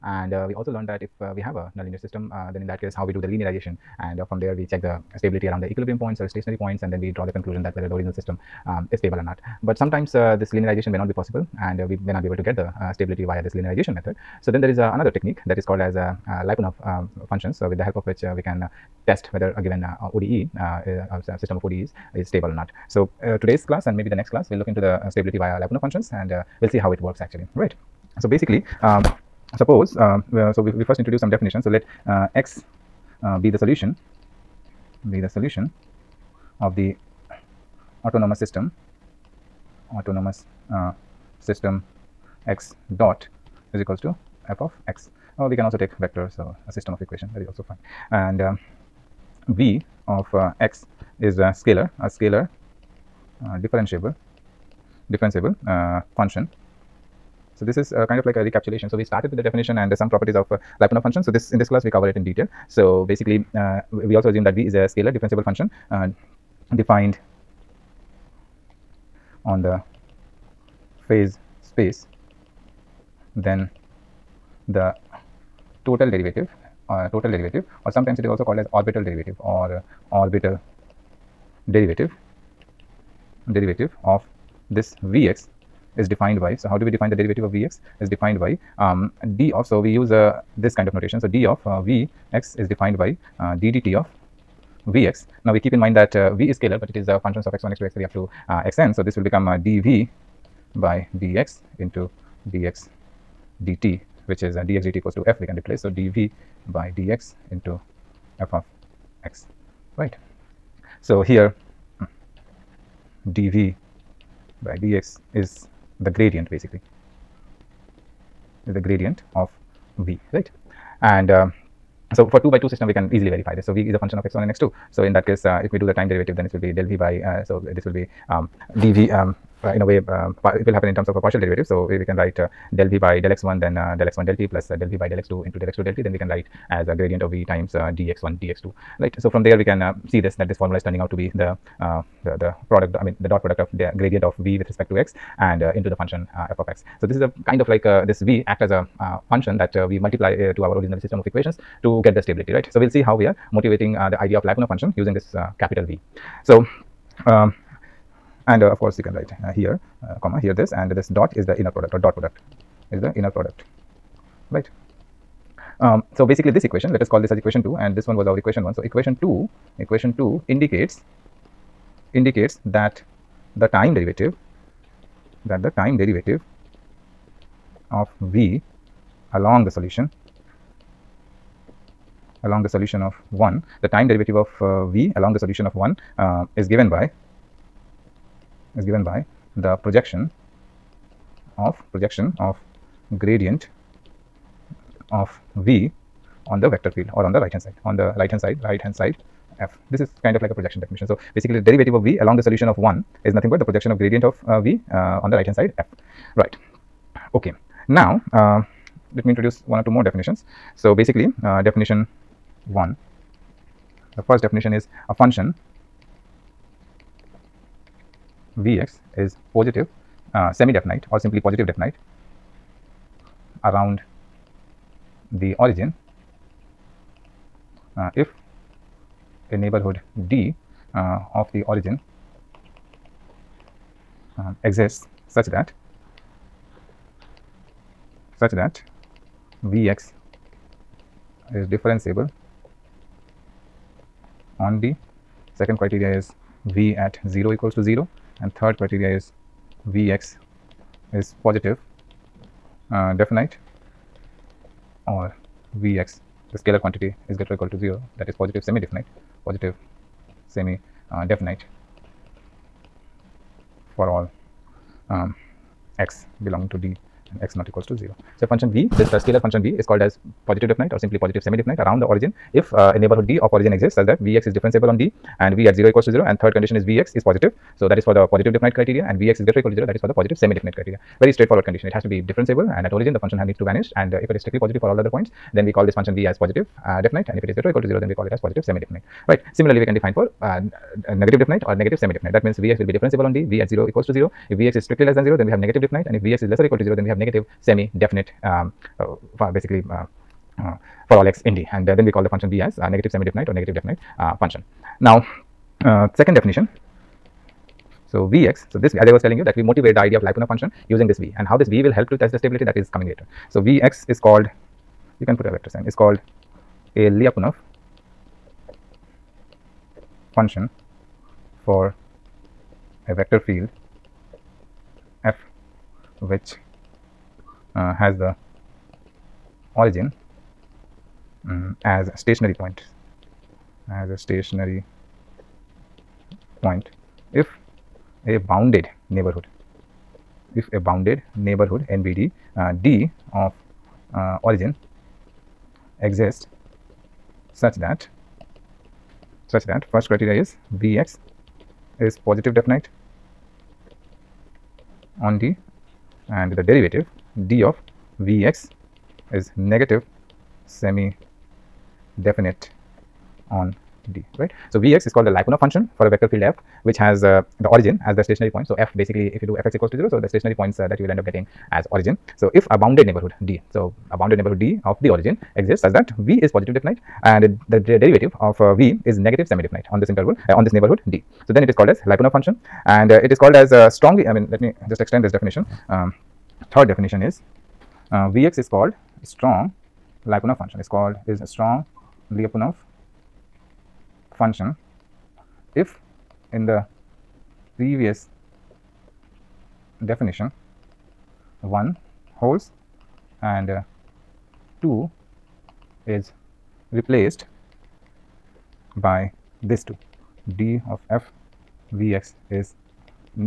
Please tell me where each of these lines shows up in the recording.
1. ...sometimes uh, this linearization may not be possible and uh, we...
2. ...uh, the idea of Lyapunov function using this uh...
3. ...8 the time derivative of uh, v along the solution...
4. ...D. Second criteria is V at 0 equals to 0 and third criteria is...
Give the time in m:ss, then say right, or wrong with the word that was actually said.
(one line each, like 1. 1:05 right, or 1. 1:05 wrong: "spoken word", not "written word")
1. 0:09 right
2. 2:33 right
3. 3:03 wrong: "1", not "8"
4. 4:04 right.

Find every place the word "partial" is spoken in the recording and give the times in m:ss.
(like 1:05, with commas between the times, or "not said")
2:11.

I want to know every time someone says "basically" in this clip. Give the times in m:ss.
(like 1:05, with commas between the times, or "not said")
0:28, 1:03, 1:56, 2:46, 3:21, 3:30, 4:59, 6:08.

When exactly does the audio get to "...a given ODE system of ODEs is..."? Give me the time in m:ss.
0:19.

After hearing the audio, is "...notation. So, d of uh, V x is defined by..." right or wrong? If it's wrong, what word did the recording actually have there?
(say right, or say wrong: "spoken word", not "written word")
right.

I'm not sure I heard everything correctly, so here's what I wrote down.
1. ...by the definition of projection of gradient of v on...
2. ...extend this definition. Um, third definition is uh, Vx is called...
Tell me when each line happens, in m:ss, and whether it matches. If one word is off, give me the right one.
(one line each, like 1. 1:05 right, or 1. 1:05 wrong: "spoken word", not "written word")
1. 3:09 wrong: "projection", not "definition"
2. 6:25 right.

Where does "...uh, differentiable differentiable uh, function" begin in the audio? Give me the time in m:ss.
0:53.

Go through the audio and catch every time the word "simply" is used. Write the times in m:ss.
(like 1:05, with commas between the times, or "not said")
3:41, 4:30.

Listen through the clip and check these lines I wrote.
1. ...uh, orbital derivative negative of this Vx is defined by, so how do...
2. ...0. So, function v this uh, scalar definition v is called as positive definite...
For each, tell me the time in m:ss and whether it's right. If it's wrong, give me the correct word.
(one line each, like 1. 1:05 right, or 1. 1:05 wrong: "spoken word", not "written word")
1. 1:20 wrong: "derivative", not "negative"
2. 4:27 wrong: "function", not "definition".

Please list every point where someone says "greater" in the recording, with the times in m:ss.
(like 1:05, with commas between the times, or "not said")
4:17, 4:39, 4:47.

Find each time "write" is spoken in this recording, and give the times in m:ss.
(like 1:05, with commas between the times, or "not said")
2:12, 2:16, 2:39.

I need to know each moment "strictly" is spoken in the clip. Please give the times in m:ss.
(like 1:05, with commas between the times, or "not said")
4:44, 4:54.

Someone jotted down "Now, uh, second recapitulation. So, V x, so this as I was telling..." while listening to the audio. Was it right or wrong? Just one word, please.
wrong.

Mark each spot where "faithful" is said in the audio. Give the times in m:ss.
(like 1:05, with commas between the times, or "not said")
not said.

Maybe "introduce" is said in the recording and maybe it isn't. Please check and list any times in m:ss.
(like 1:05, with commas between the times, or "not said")
0:30, 3:29.